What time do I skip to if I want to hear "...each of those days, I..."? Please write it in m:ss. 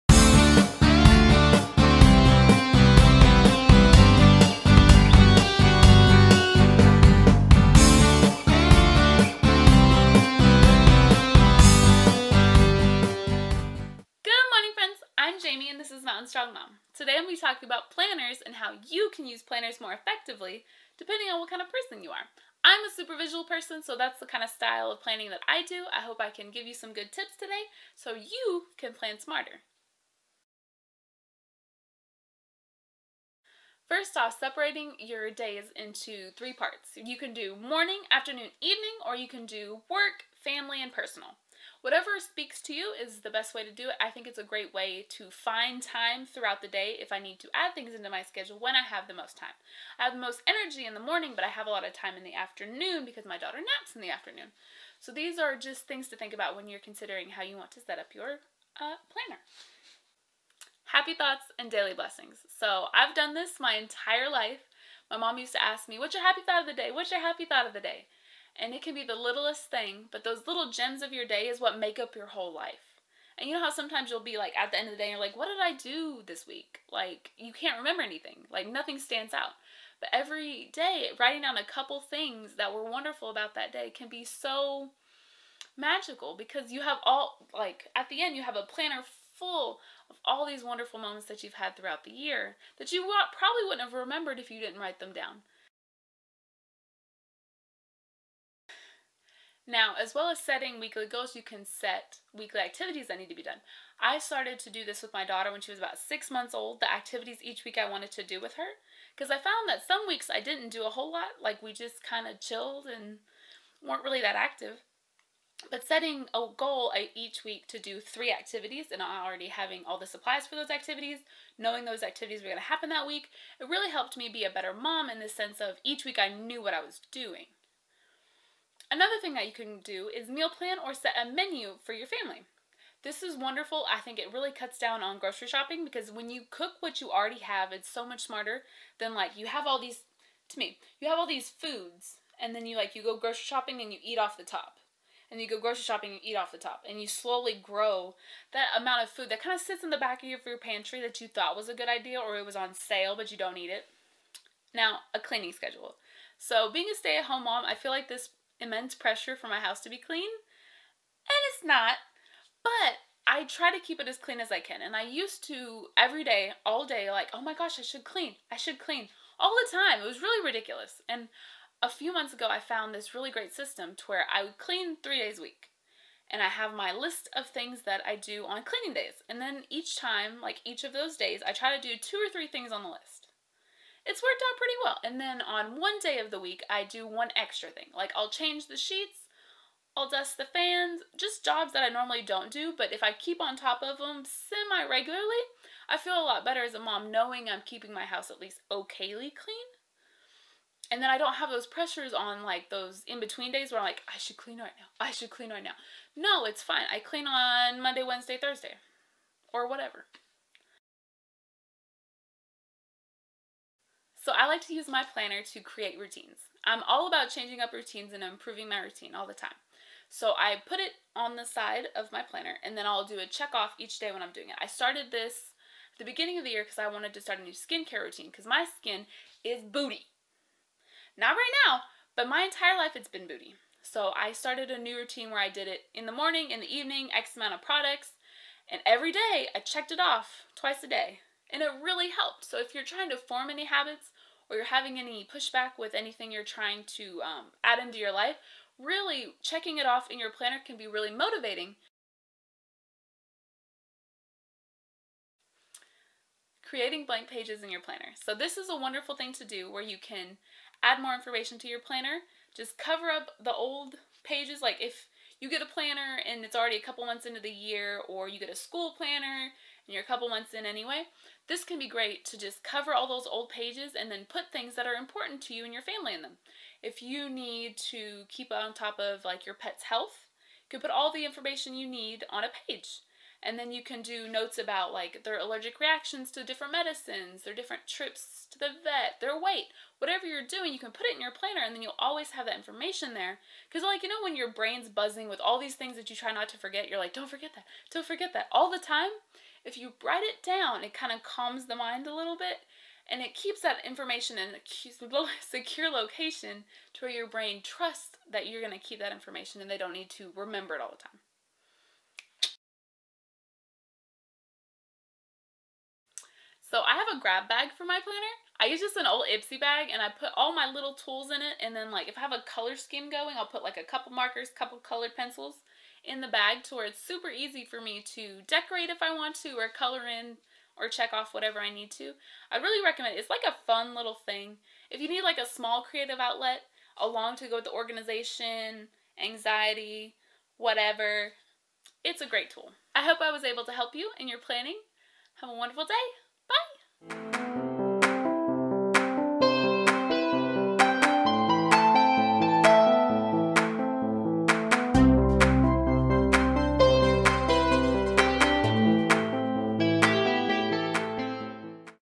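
3:00.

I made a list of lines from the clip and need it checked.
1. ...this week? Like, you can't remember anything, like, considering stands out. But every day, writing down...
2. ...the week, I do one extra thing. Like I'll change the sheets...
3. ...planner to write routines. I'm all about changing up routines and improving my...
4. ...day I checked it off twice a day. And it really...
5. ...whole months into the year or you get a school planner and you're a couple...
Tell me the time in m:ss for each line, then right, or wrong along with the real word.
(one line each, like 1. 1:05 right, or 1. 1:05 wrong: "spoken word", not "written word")
1. 1:16 wrong: "nothing", not "considering"
2. 3:06 right
3. 3:35 wrong: "create", not "write"
4. 3:59 right
5. 4:26 wrong: "couple", not "whole".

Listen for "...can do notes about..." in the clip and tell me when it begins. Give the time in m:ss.
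4:43.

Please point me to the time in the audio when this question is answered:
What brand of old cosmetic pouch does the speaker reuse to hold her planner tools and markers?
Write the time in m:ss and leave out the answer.
5:19.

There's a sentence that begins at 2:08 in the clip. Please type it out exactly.
Another thing that you can do is meal plan or set a menu for your family.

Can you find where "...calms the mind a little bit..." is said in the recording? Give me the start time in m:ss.
5:01.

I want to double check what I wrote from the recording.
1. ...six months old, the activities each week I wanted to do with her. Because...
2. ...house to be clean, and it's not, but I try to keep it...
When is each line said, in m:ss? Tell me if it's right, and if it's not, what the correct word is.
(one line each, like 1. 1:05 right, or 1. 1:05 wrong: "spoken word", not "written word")
1. 1:45 right
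2. 2:39 right.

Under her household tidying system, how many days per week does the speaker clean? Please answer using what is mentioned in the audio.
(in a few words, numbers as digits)
3.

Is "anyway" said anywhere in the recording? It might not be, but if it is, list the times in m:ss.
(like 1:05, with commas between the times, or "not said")
4:30.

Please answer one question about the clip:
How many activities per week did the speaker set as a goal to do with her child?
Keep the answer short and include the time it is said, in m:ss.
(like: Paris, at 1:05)
3, at 1:58.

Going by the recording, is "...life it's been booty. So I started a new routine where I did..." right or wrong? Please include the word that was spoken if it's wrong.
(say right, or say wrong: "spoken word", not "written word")
right.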